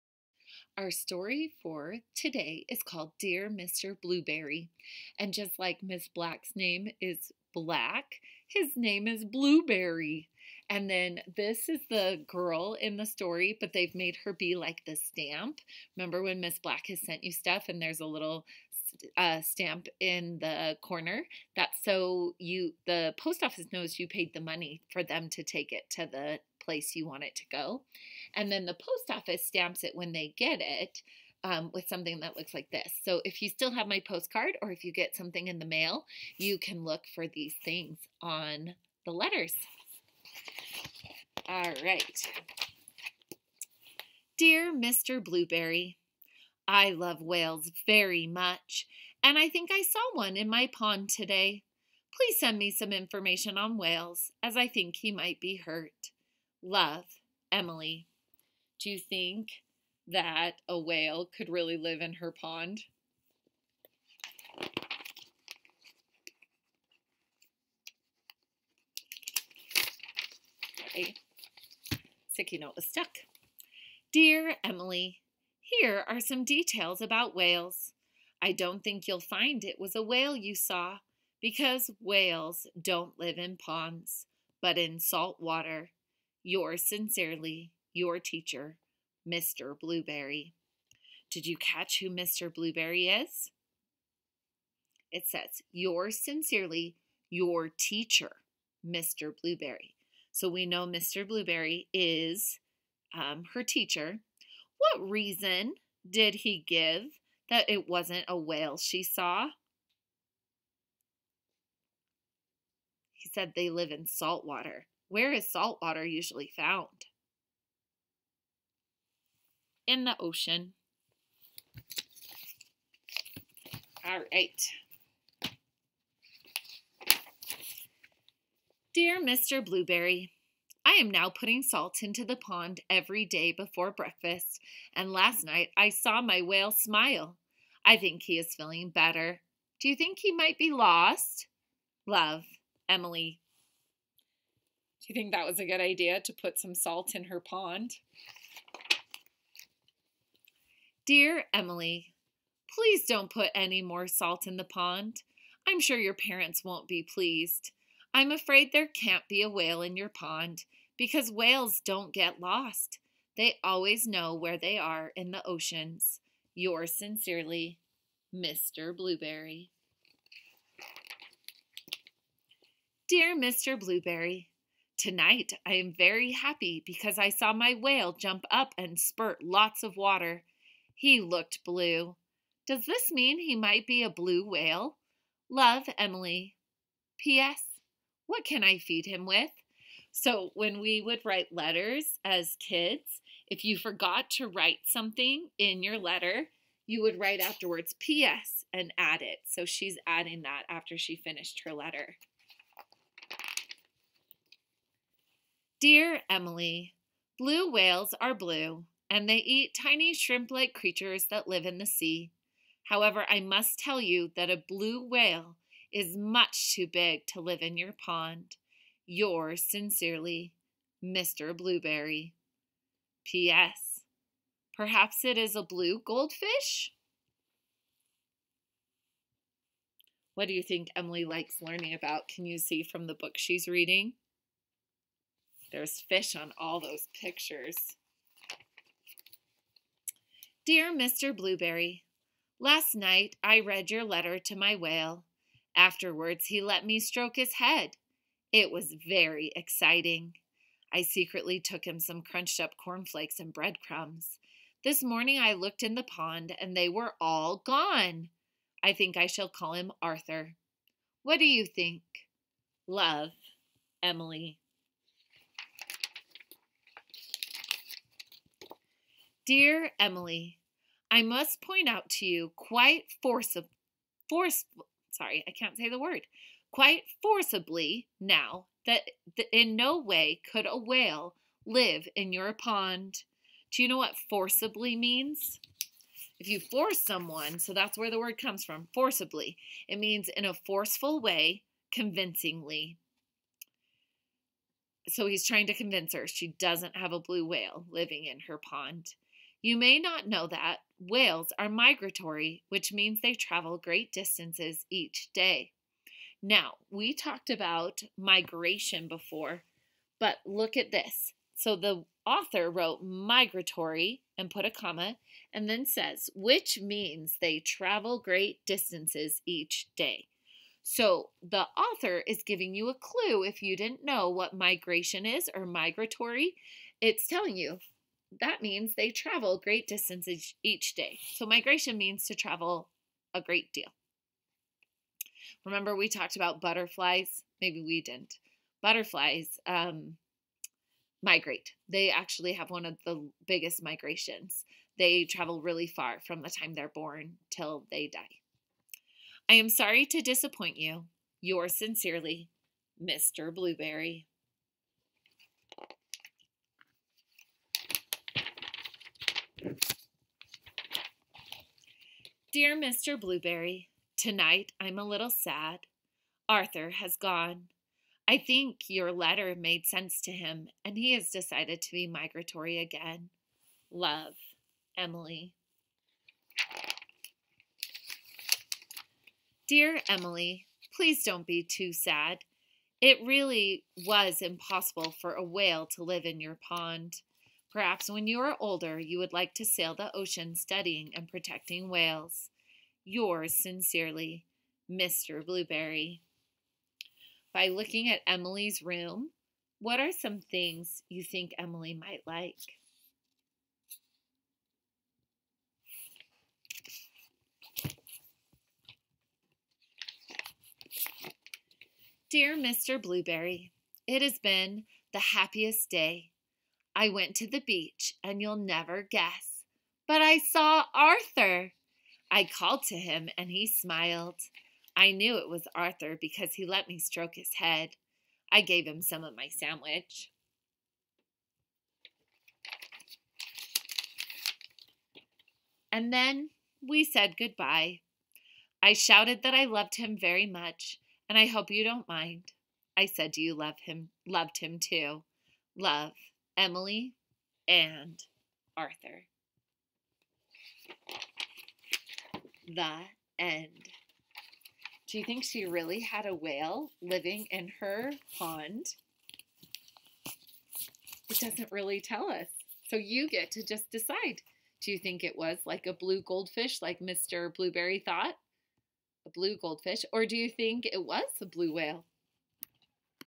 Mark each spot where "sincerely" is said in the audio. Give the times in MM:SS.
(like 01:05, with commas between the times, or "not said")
01:26, 01:36, 02:46, 03:39, 05:51, 06:33.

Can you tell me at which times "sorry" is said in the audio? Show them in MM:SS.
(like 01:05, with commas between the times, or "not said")
04:35, 05:49.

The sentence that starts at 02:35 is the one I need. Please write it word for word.
I'm sure your parents won't be pleased.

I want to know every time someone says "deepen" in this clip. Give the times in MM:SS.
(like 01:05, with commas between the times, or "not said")
not said.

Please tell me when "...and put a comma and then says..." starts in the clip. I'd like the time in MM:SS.
05:14.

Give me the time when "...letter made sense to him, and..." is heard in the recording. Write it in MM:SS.
06:09.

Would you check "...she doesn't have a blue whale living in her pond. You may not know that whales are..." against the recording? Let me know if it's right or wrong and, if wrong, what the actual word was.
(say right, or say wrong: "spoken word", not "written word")
right.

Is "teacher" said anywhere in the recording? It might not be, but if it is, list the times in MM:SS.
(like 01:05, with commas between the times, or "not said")
01:28, 01:37, 01:43.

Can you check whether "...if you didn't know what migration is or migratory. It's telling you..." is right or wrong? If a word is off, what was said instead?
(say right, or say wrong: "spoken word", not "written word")
right.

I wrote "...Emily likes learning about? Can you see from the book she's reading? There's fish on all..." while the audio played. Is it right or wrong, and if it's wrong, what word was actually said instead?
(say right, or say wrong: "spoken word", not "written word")
right.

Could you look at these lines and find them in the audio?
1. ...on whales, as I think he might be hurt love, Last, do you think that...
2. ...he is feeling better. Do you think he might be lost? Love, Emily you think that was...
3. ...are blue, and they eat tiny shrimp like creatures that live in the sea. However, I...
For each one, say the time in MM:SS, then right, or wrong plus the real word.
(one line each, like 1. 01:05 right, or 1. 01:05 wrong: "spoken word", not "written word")
1. 00:53 wrong: "Emily", not "Last"
2. 02:18 right
3. 03:28 right.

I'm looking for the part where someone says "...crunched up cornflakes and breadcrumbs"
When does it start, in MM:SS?
04:12.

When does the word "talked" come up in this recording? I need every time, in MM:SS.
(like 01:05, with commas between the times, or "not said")
05:07, 05:36.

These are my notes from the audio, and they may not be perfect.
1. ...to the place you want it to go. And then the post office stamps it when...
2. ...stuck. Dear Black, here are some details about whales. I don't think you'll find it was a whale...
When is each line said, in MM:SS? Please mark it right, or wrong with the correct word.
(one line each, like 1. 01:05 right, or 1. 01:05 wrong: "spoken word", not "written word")
1. 00:25 right
2. 01:12 wrong: "Emily", not "Black".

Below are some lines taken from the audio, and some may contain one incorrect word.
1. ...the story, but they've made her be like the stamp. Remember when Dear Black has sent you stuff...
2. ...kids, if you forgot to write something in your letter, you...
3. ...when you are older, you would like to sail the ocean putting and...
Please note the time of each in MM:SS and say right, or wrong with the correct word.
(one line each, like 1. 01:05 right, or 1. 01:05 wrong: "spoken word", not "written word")
1. 00:12 wrong: "Miss", not "Dear"
2. 03:12 right
3. 06:28 wrong: "studying", not "putting".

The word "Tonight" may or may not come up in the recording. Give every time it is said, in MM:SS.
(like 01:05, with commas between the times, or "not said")
02:55, 06:04.